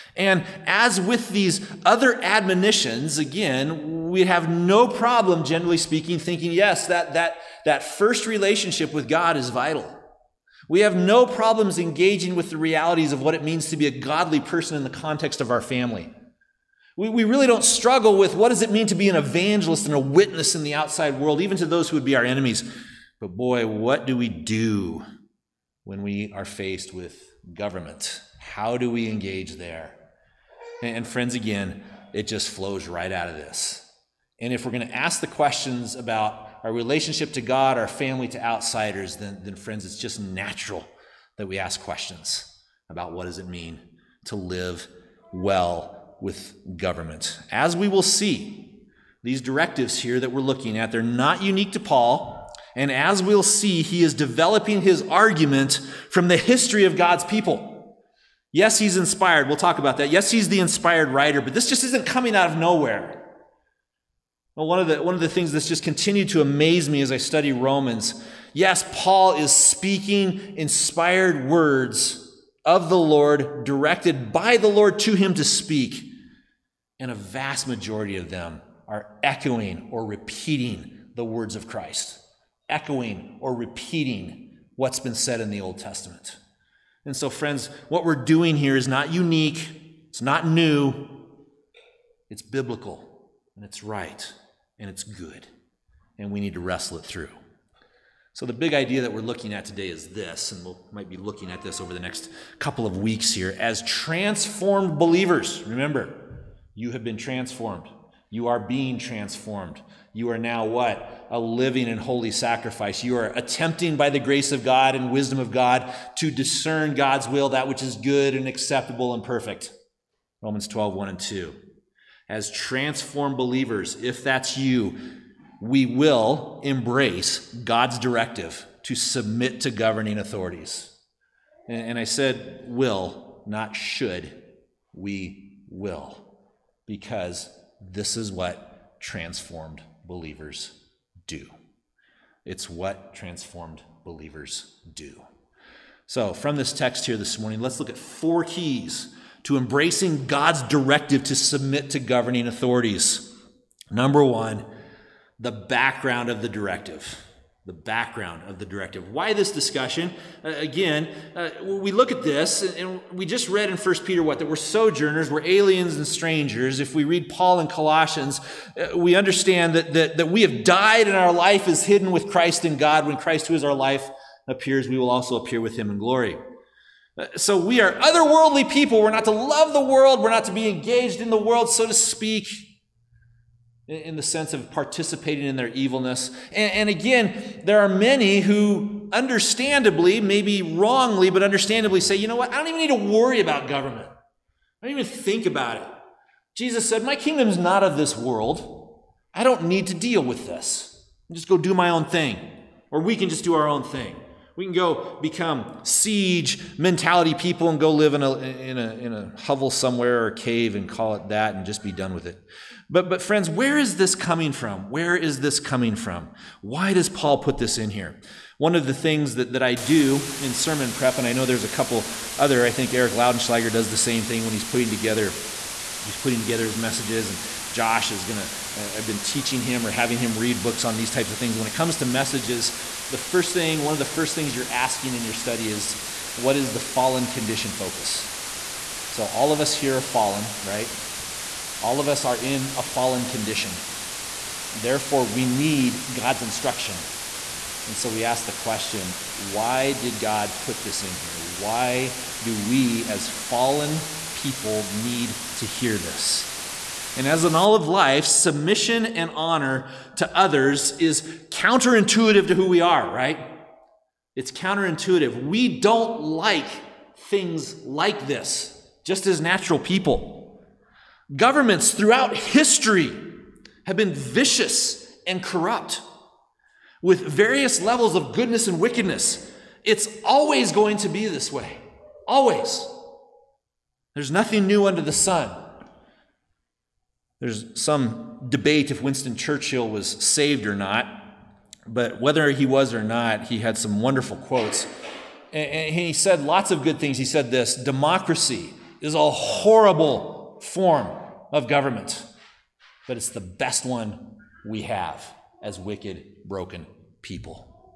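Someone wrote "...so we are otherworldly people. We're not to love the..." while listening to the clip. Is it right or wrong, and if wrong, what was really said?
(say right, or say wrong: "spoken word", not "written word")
right.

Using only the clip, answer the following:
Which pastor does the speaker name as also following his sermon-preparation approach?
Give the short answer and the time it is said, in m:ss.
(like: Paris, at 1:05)
Eric Laudenschlager, at 3:42.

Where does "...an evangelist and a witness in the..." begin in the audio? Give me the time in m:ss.
0:19.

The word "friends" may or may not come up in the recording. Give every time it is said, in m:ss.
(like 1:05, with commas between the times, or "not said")
0:31, 0:39, 1:27, 3:33.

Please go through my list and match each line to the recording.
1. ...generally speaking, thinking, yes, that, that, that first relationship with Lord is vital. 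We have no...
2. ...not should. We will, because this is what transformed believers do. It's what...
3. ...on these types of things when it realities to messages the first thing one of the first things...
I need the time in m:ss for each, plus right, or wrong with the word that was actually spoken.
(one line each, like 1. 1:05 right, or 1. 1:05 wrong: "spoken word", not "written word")
1. 0:05 wrong: "God", not "Lord"
2. 2:13 right
3. 3:50 wrong: "comes", not "realities".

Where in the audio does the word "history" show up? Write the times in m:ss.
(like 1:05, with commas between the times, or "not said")
0:56, 4:32.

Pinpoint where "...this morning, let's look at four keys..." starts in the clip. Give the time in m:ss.
2:27.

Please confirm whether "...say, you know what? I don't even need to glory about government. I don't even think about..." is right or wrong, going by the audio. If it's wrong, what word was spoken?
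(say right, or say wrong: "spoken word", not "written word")
wrong: "worry", not "glory".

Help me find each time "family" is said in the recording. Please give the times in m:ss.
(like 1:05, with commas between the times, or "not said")
0:15, 0:37.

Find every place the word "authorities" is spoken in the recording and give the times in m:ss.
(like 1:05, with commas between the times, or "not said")
2:10, 2:32.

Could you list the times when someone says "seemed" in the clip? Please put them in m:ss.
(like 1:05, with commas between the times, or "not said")
not said.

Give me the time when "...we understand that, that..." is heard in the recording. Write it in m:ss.
2:48.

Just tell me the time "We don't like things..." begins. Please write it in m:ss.
4:25.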